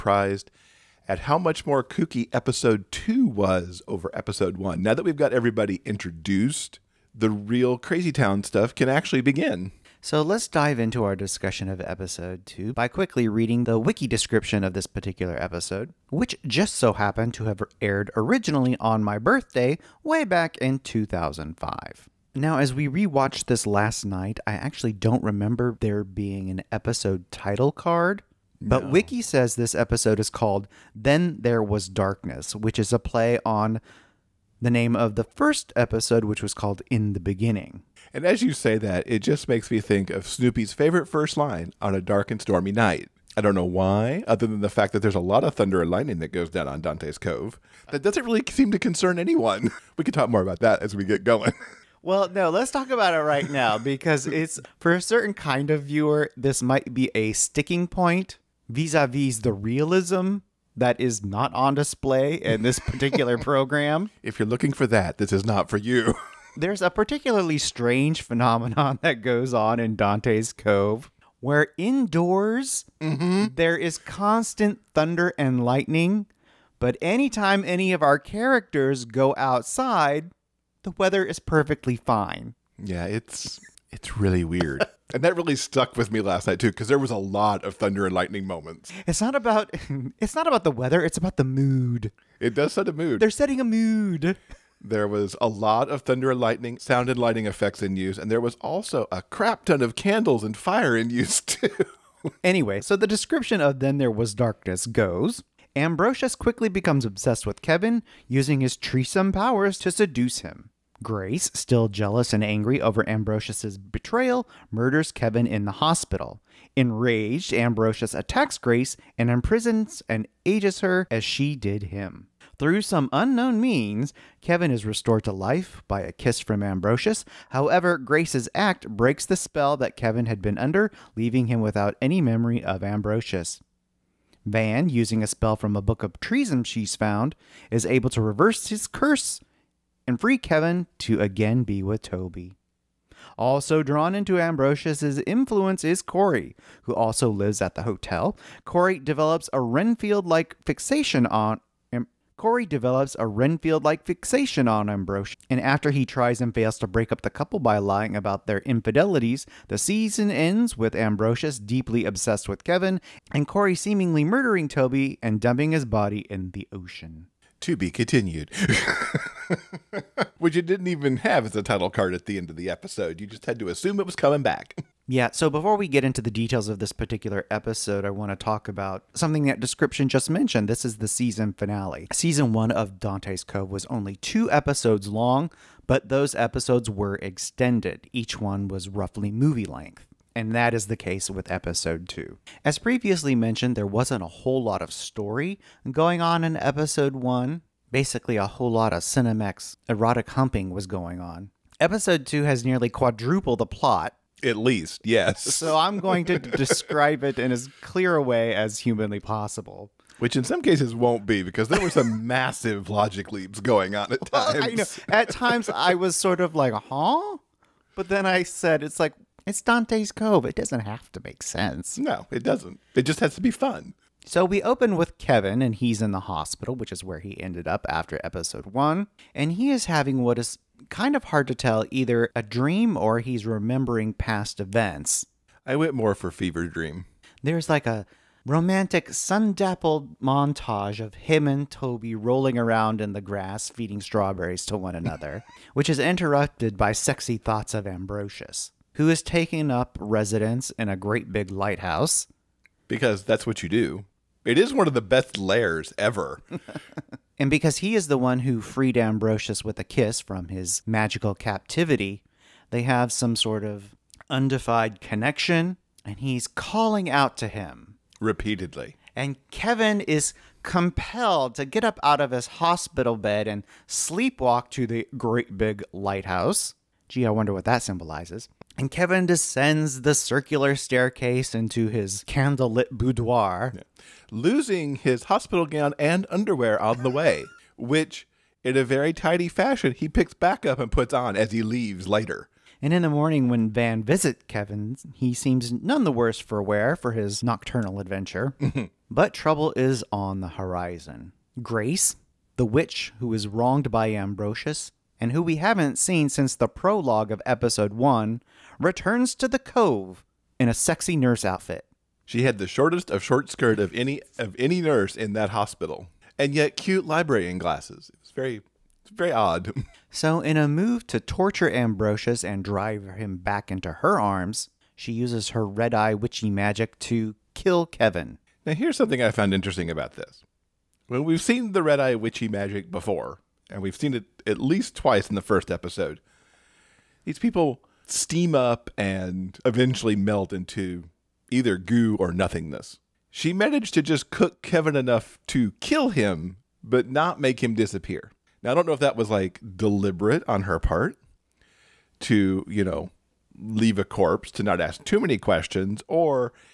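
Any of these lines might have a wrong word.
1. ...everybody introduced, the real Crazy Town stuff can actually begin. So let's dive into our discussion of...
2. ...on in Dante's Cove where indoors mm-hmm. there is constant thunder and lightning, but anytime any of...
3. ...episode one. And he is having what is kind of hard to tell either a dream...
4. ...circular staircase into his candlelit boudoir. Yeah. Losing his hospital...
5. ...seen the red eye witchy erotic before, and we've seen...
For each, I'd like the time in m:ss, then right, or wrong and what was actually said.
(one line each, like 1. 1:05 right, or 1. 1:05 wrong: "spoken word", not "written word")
1. 0:05 right
2. 1:09 right
3. 3:48 right
4. 4:40 right
5. 5:31 wrong: "magic", not "erotic".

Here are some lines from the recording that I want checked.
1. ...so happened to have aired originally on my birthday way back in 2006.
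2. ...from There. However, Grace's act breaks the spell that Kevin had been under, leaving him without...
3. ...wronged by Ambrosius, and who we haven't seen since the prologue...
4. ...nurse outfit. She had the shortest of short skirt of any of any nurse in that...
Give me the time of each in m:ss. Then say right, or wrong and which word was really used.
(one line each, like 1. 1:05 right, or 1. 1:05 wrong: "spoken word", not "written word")
1. 0:16 wrong: "2005", not "2006"
2. 2:06 wrong: "Ambrosius", not "There"
3. 5:03 right
4. 5:11 right.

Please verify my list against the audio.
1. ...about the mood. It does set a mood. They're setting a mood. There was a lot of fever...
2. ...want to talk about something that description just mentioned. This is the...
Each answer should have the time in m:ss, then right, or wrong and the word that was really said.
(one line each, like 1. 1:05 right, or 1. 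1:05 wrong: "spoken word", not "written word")
1. 1:31 wrong: "thunder", not "fever"
2. 2:58 right.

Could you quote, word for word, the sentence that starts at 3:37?
But then I said, it's like, it's Dante's Cove.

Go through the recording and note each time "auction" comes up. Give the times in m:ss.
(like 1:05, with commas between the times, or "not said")
not said.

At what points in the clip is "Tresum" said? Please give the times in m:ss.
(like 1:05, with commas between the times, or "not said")
1:48, 2:16.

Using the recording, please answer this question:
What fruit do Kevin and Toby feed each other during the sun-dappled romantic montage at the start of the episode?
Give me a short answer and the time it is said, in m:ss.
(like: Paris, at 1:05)
Strawberries, at 4:04.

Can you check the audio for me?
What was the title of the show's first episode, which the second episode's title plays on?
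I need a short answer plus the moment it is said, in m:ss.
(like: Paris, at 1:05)
In the Beginning, at 0:36.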